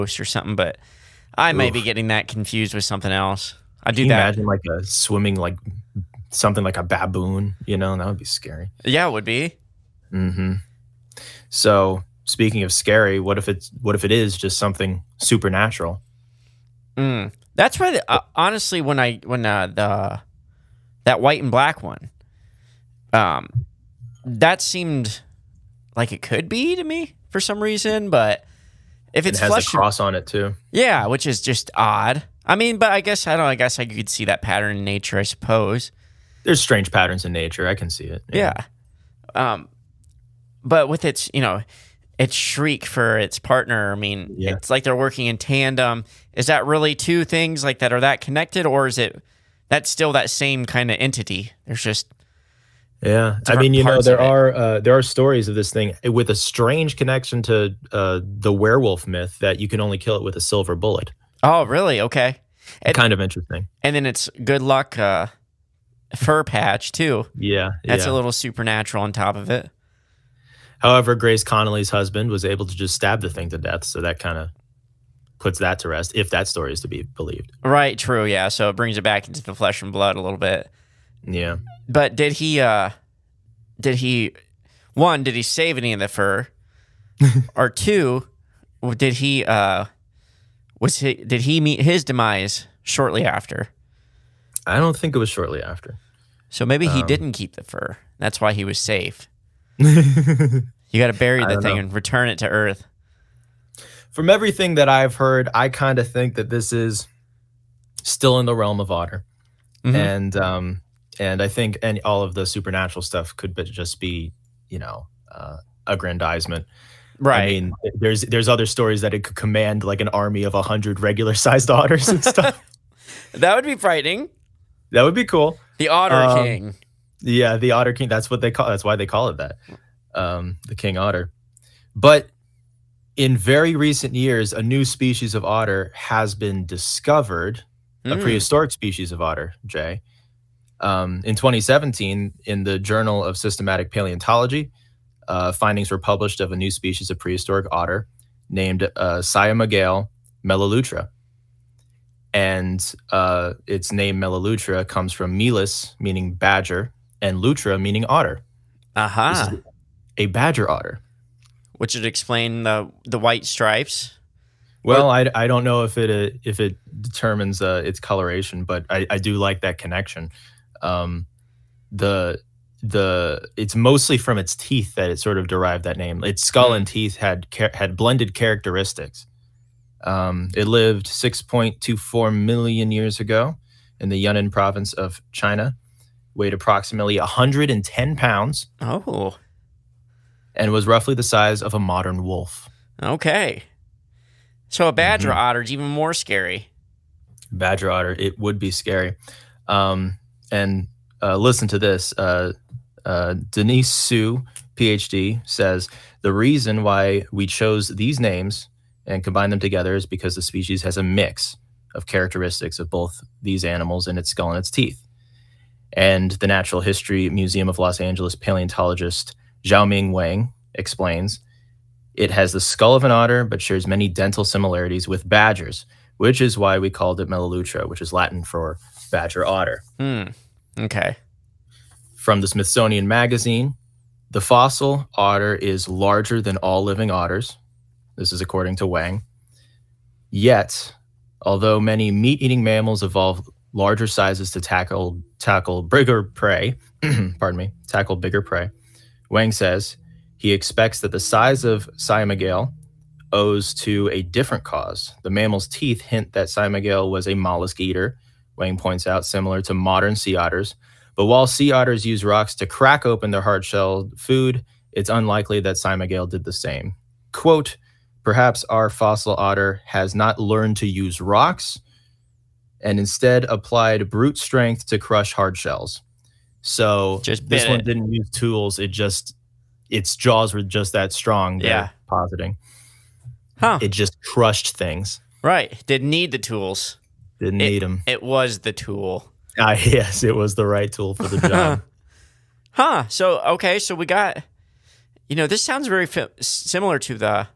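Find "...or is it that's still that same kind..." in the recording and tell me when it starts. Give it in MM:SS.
00:48.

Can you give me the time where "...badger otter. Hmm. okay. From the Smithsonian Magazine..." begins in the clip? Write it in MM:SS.
03:49.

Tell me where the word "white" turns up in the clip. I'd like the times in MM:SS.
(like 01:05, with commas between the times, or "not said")
00:21, 02:43.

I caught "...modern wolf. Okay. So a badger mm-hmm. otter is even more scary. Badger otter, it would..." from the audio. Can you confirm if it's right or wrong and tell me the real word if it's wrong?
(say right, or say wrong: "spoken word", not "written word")
right.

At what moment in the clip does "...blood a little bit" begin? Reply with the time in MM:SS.
01:19.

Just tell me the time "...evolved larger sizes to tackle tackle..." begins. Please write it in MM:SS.
04:03.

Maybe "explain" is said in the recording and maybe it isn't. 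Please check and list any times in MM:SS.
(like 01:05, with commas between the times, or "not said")
02:42, 03:40.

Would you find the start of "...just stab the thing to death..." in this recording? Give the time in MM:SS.
01:12.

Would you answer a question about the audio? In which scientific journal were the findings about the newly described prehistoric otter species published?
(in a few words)
Journal of Systematic Paleontology.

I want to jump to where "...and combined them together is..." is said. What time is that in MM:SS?
03:29.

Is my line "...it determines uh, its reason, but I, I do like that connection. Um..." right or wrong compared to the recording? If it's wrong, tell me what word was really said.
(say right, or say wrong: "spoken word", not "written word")
wrong: "coloration", not "reason".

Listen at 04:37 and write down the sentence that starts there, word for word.
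didn't use tools; it just its jaws were just that strong.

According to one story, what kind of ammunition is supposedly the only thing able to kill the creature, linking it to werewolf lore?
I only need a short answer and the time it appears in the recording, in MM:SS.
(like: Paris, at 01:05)
a silver bullet, at 01:00.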